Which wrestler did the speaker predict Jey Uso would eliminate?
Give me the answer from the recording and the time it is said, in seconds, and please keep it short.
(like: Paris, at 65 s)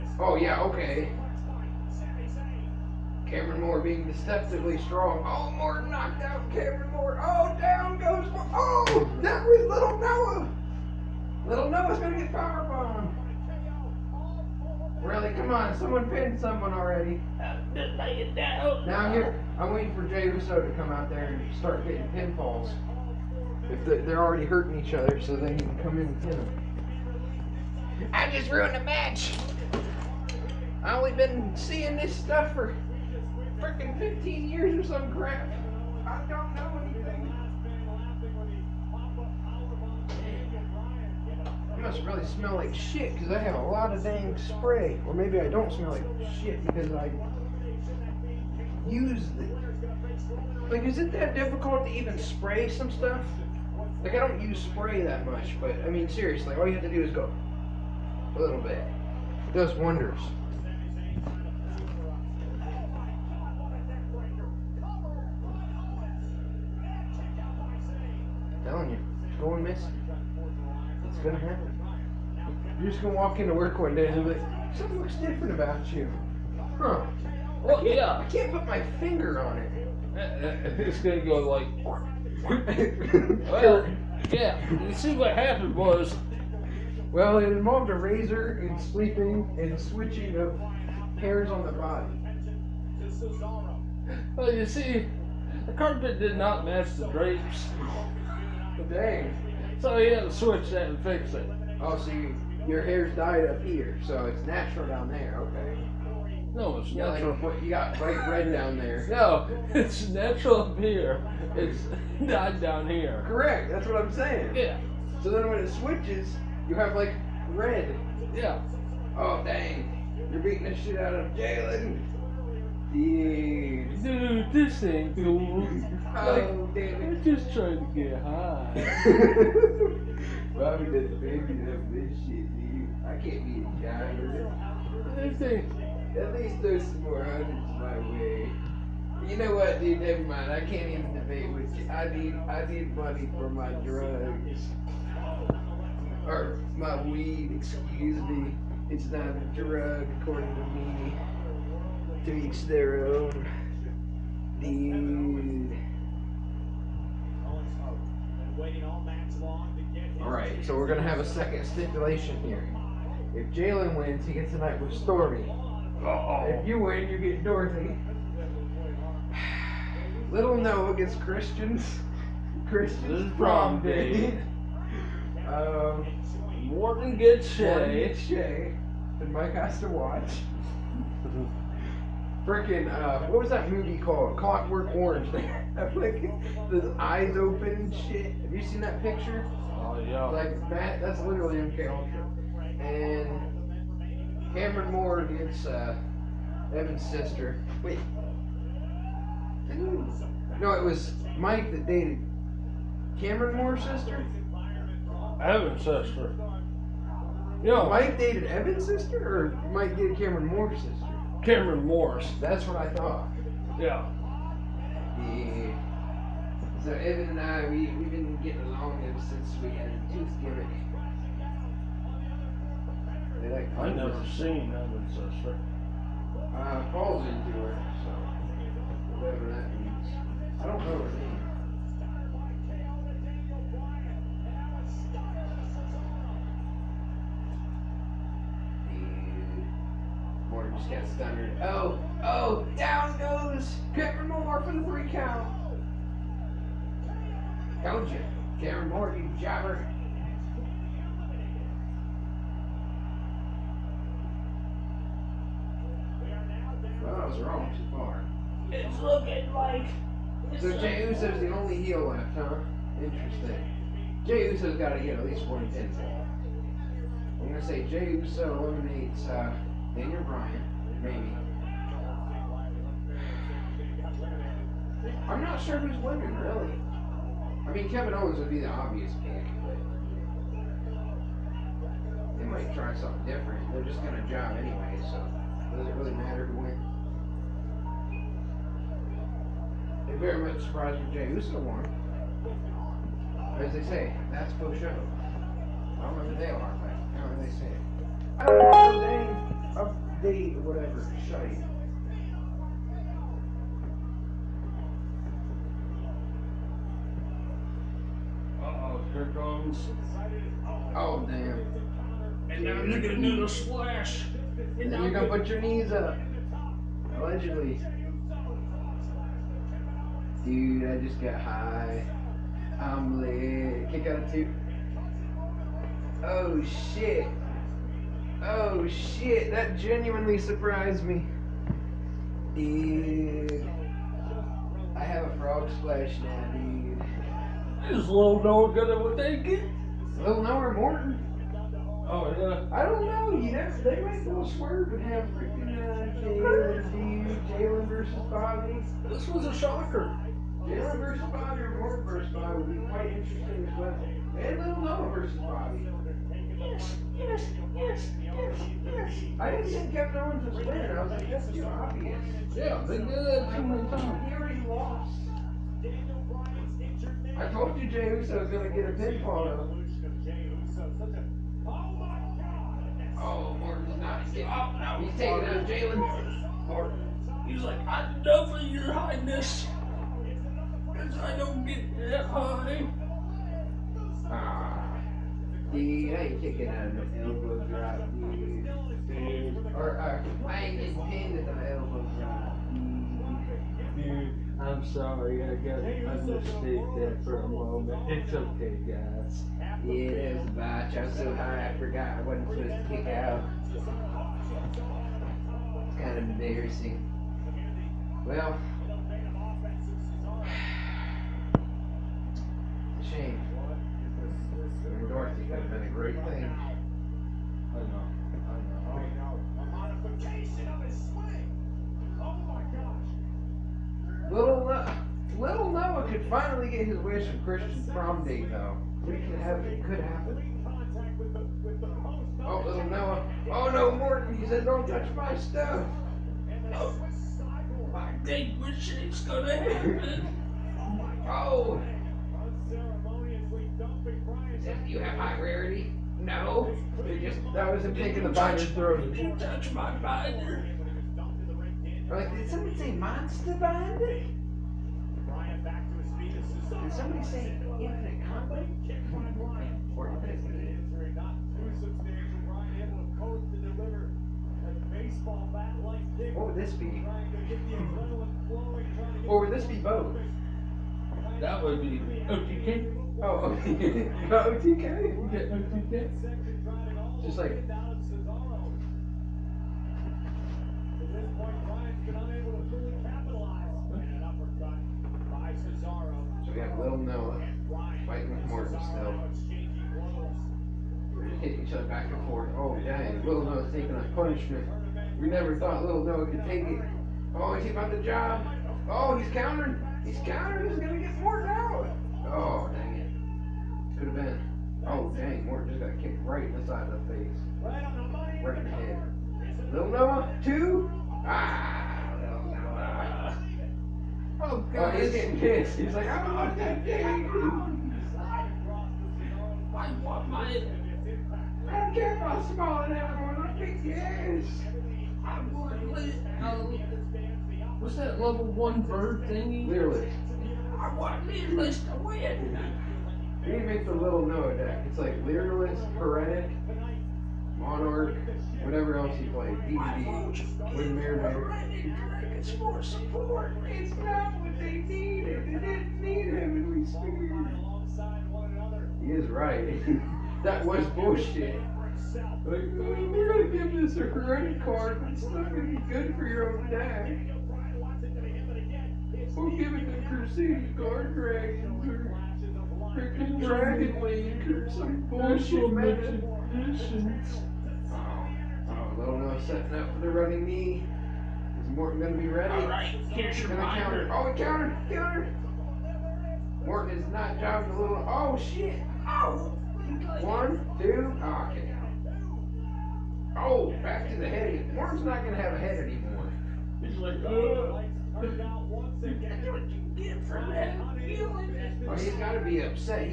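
Daniel Bryan, at 269 s.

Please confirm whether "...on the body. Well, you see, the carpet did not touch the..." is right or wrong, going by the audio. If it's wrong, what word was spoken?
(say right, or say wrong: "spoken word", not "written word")
wrong: "match", not "touch".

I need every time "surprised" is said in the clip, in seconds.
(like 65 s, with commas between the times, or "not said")
290 s, 330 s.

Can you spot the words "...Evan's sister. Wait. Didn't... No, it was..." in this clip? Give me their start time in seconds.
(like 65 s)
196 s.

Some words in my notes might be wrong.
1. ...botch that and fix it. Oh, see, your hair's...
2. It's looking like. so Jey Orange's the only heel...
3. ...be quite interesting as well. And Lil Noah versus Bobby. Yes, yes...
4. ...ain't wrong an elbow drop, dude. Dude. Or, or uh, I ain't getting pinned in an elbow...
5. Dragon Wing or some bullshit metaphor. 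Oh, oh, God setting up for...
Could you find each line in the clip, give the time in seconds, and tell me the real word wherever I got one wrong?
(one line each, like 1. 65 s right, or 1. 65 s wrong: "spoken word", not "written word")
1. 100 s wrong: "switch", not "botch"
2. 258 s wrong: "Uso", not "Orange"
3. 352 s right
4. 386 s wrong: "taking", not "wrong"
5. 563 s wrong: "Lola", not "God".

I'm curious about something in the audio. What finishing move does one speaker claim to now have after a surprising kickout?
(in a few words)
frog splash.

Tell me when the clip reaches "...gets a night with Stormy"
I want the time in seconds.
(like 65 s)
164 s.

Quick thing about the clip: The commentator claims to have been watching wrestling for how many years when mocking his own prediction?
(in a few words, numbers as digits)
15.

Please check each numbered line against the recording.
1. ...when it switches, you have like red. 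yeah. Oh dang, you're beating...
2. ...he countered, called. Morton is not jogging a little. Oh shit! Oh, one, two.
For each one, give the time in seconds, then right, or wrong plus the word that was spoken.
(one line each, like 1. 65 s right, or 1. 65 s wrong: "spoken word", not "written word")
1. 115 s right
2. 574 s wrong: "countered", not "called".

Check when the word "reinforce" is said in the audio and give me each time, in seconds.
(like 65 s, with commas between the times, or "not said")
not said.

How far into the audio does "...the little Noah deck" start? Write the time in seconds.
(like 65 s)
533 s.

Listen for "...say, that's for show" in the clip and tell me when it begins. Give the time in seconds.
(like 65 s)
293 s.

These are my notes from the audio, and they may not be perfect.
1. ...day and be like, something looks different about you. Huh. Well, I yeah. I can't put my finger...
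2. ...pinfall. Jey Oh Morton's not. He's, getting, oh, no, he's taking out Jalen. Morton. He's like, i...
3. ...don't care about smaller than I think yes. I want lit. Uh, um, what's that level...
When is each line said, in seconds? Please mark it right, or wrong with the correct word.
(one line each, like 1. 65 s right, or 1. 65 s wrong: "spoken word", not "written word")
1. 73 s right
2. 368 s right
3. 521 s right.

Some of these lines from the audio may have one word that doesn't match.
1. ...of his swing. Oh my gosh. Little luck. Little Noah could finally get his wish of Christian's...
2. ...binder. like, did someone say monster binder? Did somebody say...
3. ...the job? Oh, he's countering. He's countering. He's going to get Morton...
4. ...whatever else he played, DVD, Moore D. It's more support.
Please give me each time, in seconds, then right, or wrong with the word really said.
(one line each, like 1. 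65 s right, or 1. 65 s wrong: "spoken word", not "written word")
1. 420 s right
2. 449 s right
3. 497 s right
4. 538 s wrong: "Windmere", not "Moore".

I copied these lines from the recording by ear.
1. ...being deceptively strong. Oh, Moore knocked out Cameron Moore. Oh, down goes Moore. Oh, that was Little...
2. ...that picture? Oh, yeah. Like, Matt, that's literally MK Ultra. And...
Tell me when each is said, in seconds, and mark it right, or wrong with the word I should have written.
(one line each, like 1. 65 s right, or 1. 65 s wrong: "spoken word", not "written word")
1. 3 s right
2. 188 s right.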